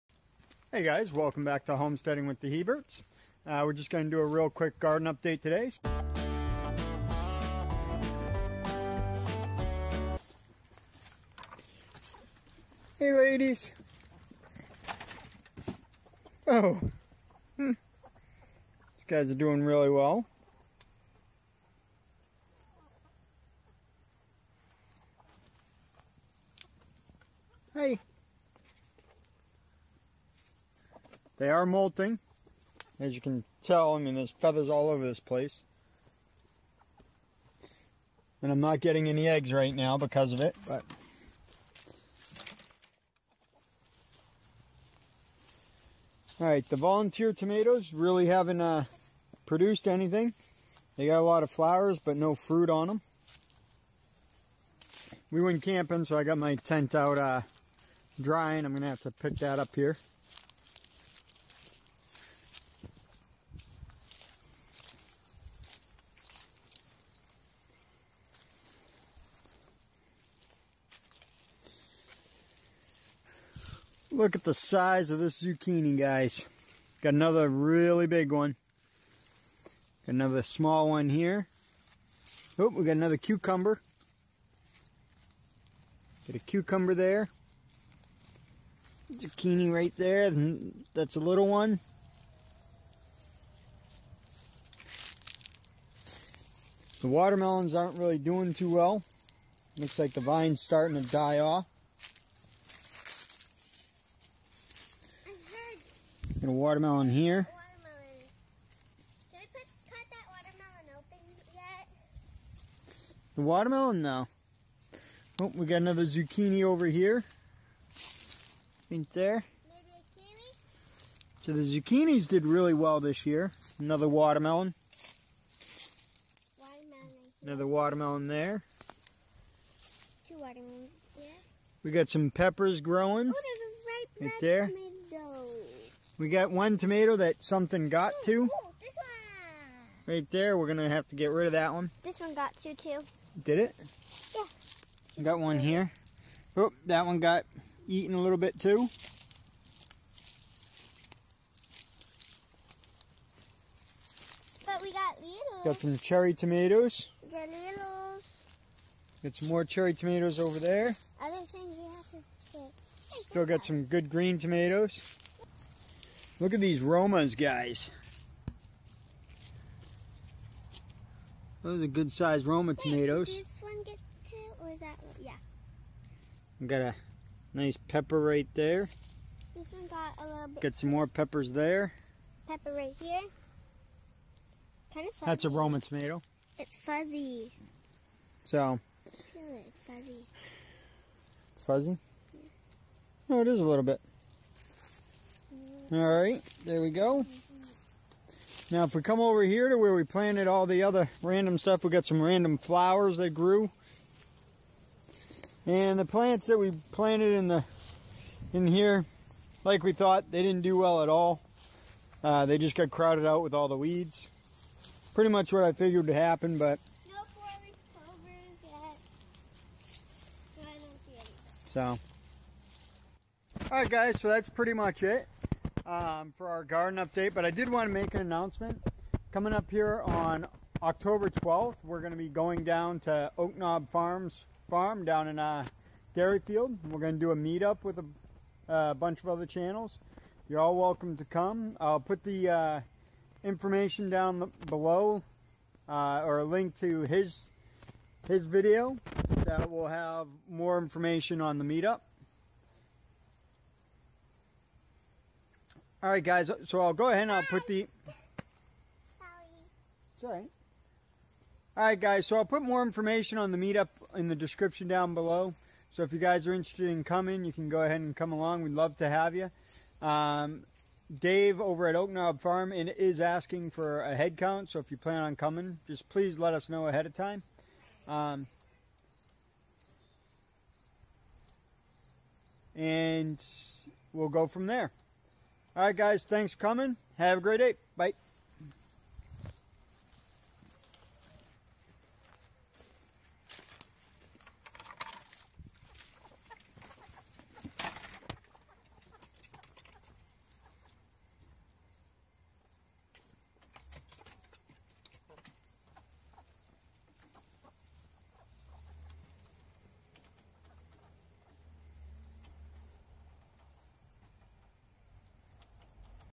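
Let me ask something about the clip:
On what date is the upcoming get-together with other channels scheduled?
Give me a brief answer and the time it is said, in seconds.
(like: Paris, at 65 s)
October 12, at 230 s.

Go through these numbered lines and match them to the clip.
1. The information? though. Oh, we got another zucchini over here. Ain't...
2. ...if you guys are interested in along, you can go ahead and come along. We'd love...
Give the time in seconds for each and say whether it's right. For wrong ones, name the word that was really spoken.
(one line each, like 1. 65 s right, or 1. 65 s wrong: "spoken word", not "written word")
1. 113 s wrong: "watermelon", not "information"
2. 266 s wrong: "coming", not "along".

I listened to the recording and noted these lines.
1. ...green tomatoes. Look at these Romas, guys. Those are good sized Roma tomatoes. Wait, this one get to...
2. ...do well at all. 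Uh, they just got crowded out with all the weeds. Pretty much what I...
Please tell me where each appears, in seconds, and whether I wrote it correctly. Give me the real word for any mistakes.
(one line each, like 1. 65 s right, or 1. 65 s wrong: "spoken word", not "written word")
1. 164 s right
2. 210 s right.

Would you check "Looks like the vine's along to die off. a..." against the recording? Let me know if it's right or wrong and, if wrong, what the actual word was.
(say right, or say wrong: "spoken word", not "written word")
wrong: "starting", not "along".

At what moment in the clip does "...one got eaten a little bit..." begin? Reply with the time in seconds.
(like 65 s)
147 s.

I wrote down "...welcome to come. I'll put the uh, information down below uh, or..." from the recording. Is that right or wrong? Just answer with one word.
right.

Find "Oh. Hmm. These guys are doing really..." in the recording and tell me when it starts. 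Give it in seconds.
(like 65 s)
16 s.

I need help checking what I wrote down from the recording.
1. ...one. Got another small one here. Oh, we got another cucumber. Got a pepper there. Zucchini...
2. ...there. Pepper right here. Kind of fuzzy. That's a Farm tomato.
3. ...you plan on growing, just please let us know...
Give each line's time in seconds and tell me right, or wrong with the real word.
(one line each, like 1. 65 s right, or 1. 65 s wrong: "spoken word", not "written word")
1. 78 s wrong: "cucumber", not "pepper"
2. 181 s wrong: "Roma", not "Farm"
3. 274 s wrong: "coming", not "growing".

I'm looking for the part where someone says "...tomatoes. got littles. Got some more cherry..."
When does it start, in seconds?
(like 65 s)
156 s.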